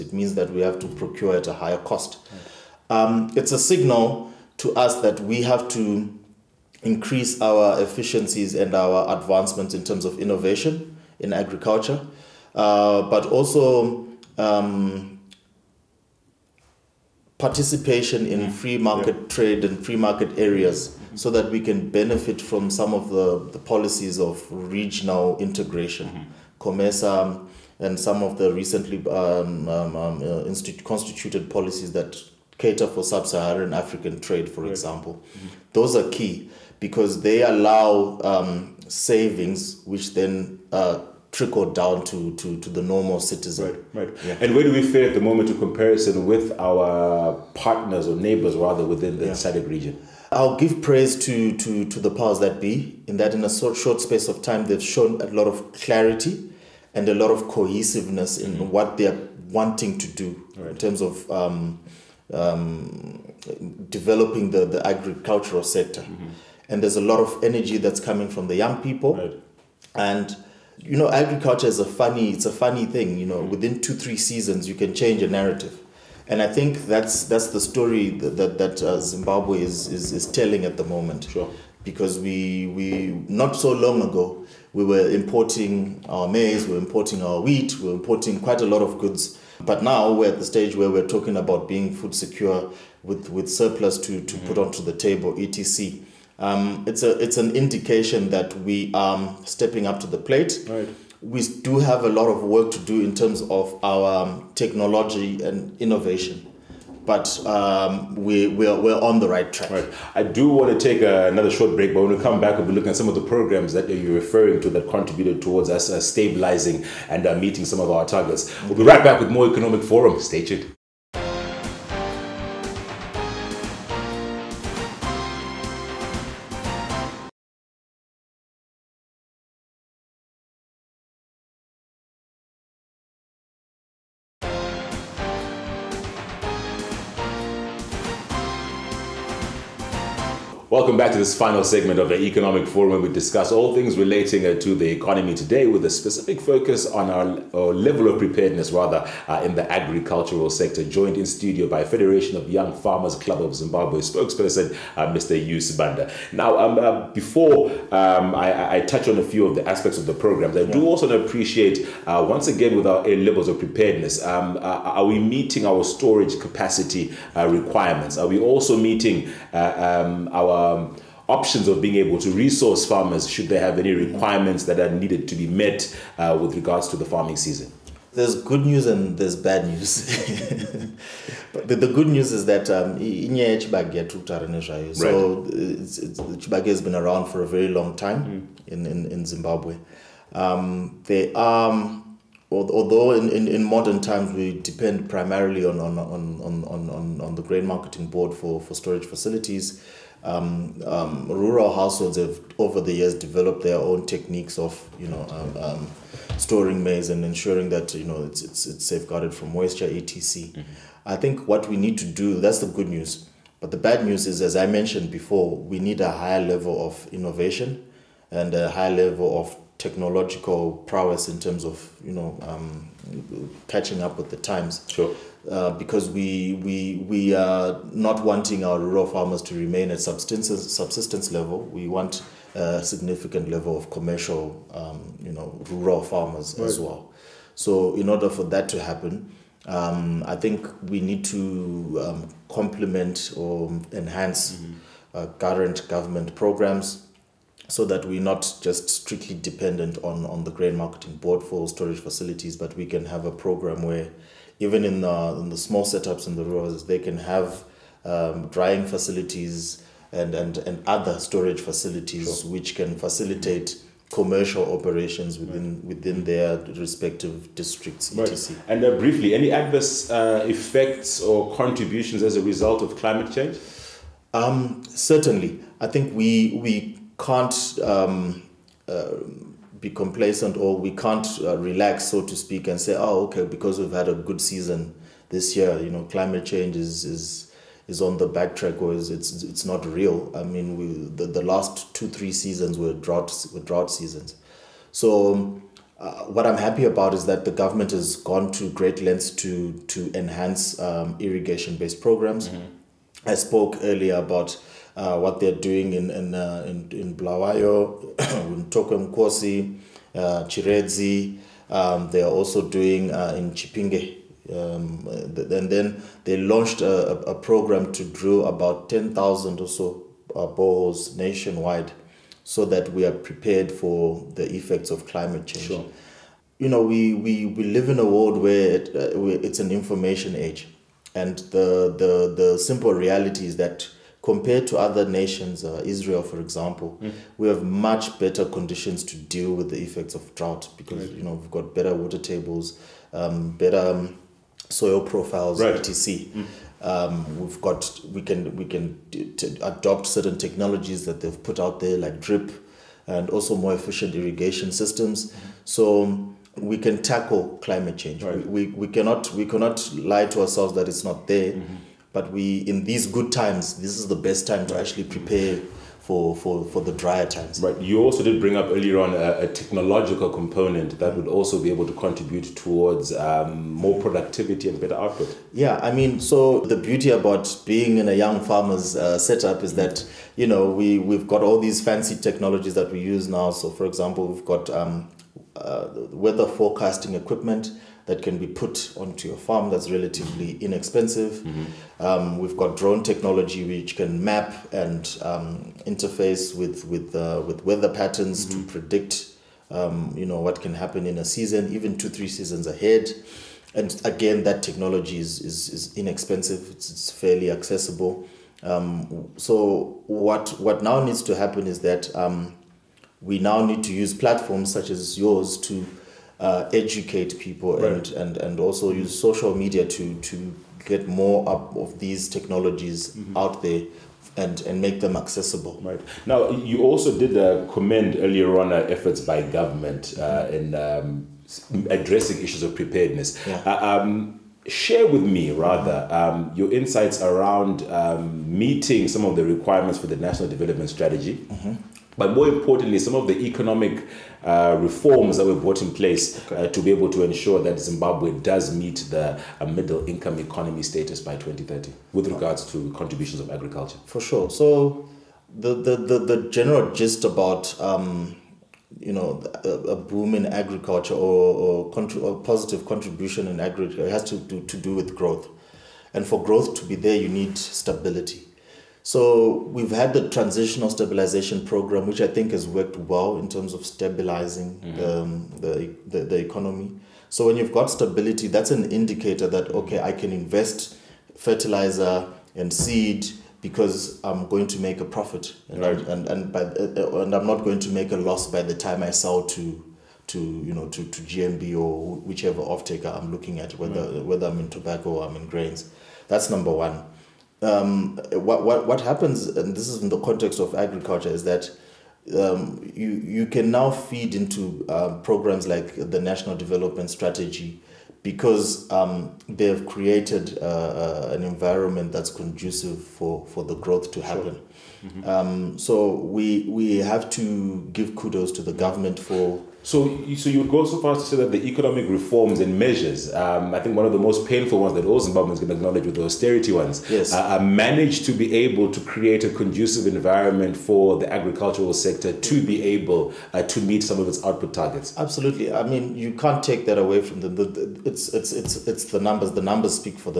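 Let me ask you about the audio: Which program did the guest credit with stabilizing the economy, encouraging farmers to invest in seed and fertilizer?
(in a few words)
Transitional Stabilization Program.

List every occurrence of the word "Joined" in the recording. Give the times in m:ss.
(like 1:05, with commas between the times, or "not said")
2:30.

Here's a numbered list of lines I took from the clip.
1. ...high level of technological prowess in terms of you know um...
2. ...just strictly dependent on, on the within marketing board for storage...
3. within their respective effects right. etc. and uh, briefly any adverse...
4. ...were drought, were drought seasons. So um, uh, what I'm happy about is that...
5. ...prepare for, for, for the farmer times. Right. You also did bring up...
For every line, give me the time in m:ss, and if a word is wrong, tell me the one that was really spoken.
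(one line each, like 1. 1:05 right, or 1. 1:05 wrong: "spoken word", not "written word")
1. 3:38 right
2. 4:08 wrong: "grain", not "within"
3. 4:25 wrong: "districts", not "effects"
4. 4:52 right
5. 6:05 wrong: "drier", not "farmer".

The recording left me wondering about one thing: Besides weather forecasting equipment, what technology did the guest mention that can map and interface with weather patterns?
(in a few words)
Drone technology.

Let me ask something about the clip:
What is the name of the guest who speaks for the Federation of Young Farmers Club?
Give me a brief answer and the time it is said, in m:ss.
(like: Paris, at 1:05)
Hugh Sibanda, at 2:35.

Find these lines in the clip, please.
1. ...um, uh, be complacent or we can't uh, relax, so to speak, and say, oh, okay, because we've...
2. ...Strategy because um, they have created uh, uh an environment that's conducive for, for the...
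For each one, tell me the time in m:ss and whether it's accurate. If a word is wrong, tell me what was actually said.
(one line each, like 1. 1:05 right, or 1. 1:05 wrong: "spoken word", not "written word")
1. 4:37 right
2. 8:27 right.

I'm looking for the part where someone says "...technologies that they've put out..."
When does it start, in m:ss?
5:50.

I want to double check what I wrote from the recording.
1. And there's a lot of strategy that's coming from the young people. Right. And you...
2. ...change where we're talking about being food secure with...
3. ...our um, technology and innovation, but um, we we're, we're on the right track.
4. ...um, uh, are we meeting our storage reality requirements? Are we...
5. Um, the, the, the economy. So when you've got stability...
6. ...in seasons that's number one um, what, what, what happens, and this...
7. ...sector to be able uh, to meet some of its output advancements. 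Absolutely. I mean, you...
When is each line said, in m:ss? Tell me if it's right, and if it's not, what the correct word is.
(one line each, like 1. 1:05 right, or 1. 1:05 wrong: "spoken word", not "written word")
1. 1:06 wrong: "energy", not "strategy"
2. 1:30 wrong: "stage", not "change"
3. 1:43 right
4. 2:44 wrong: "capacity", not "reality"
5. 7:55 right
6. 8:15 wrong: "grains", not "seasons"
7. 8:51 wrong: "targets", not "advancements".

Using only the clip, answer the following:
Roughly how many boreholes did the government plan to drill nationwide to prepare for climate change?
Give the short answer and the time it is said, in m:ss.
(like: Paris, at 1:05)
10,000, at 5:18.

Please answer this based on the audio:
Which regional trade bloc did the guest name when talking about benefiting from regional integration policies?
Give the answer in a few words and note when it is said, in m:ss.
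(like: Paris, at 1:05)
COMESA, at 0:26.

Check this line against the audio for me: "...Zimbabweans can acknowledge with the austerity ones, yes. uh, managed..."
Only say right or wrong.
right.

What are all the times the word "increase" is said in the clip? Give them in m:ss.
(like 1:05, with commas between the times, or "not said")
0:06.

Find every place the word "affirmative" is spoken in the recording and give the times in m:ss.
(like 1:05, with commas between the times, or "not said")
not said.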